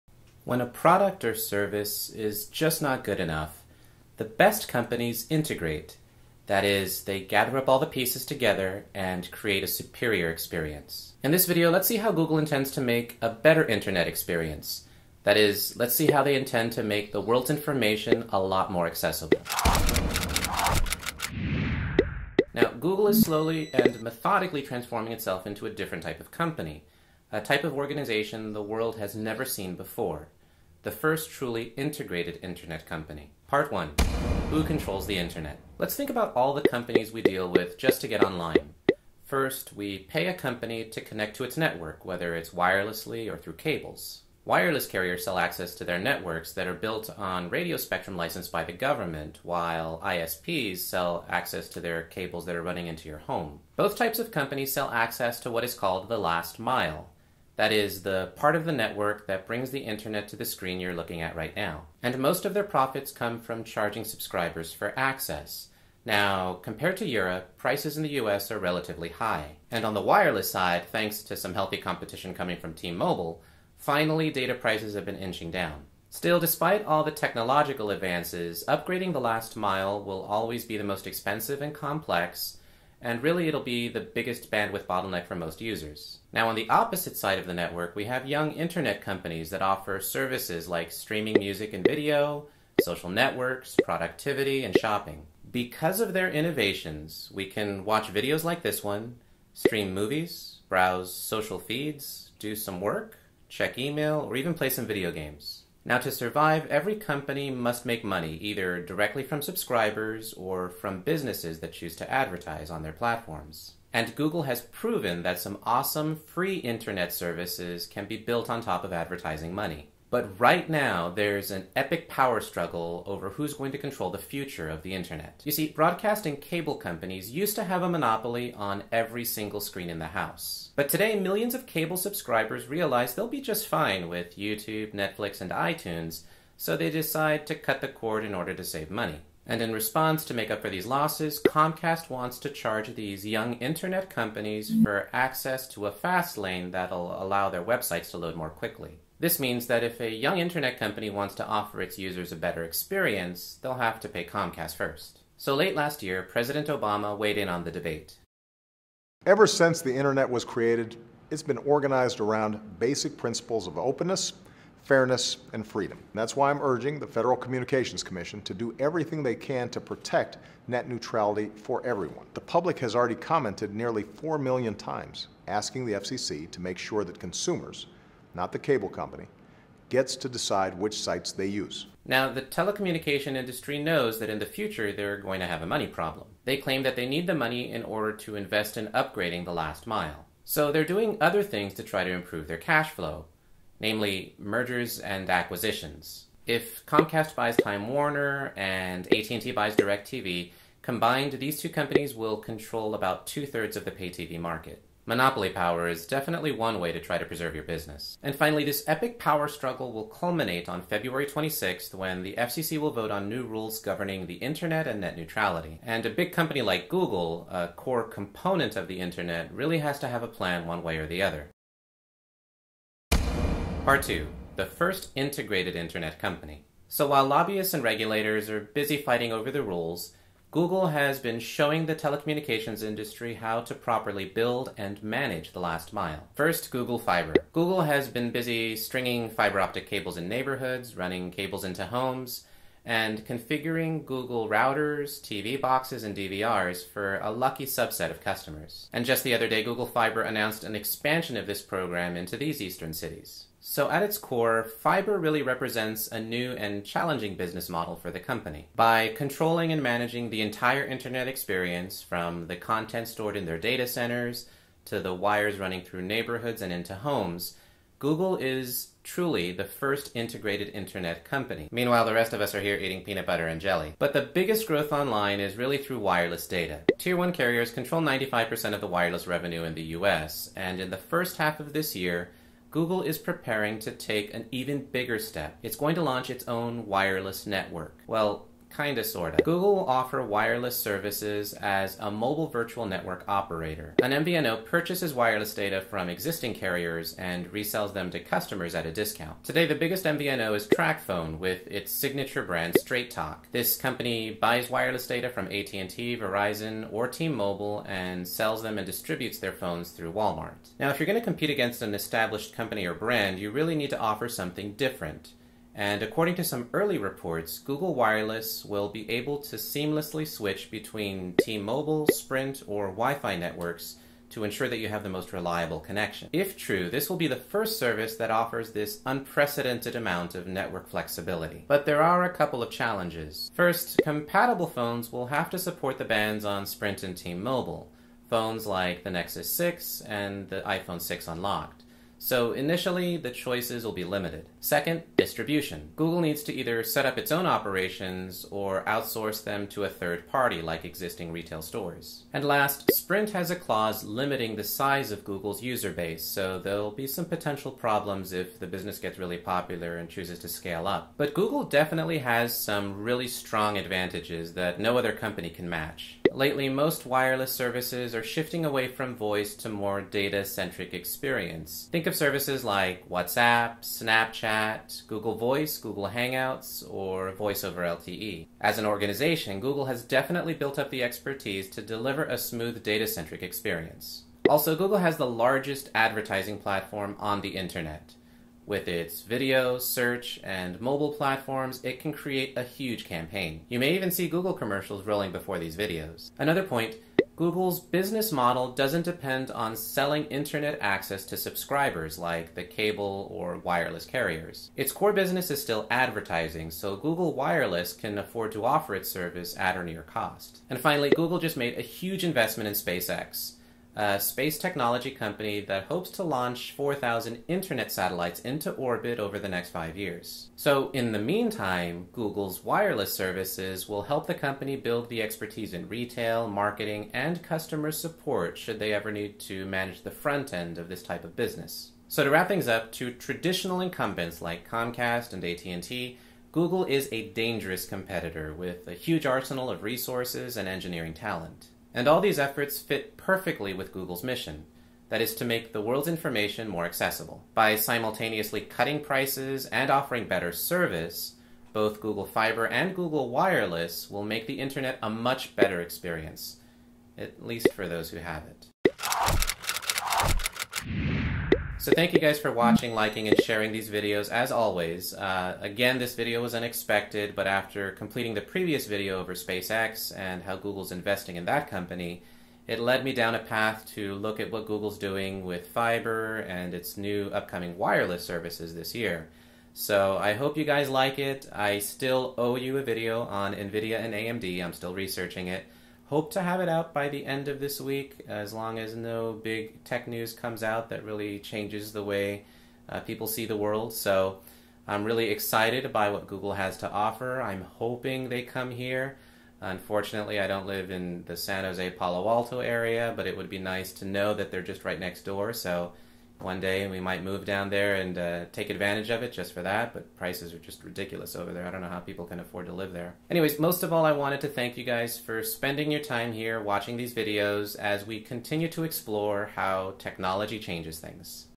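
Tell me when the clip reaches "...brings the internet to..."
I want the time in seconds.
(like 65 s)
59 s.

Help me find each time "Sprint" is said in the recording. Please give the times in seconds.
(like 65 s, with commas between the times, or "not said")
322 s, 336 s, 352 s.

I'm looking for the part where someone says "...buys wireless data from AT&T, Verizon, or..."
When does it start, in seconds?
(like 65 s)
304 s.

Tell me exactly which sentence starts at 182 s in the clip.
Now, the telecommunication industry knows that in the future they're going to have a money problem.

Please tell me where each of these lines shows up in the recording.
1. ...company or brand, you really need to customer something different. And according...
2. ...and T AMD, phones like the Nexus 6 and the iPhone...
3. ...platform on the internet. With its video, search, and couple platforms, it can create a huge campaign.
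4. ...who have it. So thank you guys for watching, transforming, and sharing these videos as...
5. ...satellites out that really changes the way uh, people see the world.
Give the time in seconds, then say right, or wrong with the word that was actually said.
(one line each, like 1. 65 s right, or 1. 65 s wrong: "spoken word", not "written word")
1. 312 s wrong: "offer", not "customer"
2. 337 s wrong: "Mobile", not "AMD"
3. 386 s wrong: "mobile", not "couple"
4. 458 s wrong: "liking", not "transforming"
5. 490 s wrong: "comes", not "satellites".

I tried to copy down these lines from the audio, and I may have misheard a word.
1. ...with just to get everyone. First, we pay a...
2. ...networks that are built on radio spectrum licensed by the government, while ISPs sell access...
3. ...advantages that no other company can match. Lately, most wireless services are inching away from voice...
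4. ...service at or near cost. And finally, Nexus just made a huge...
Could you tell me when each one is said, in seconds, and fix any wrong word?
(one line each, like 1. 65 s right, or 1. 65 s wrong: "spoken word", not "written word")
1. 37 s wrong: "online", not "everyone"
2. 45 s right
3. 363 s wrong: "shifting", not "inching"
4. 409 s wrong: "Google", not "Nexus".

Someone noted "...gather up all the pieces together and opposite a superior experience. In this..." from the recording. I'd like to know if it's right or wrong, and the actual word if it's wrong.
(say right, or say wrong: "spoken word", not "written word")
wrong: "create", not "opposite".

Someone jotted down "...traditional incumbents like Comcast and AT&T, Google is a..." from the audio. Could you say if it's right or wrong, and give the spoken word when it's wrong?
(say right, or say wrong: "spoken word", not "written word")
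right.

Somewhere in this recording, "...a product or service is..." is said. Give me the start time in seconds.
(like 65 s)
0 s.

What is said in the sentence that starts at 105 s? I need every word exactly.
Now, to survive, every company must make money either directly from subscribers or from businesses that choose to advertise on their platforms.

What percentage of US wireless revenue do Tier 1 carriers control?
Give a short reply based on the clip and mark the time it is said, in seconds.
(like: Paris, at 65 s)
95%, at 278 s.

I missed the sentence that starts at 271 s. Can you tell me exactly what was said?
Meanwhile, the rest of us are here eating peanut butter and jelly.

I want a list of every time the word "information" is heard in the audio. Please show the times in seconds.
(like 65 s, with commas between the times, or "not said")
17 s, 446 s.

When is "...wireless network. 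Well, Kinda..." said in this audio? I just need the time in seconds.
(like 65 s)
286 s.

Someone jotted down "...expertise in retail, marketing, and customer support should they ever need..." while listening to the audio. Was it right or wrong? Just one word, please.
right.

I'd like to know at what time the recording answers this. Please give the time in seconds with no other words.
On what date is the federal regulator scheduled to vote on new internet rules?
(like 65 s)
210 s.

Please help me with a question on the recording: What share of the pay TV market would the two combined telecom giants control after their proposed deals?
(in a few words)
two-thirds.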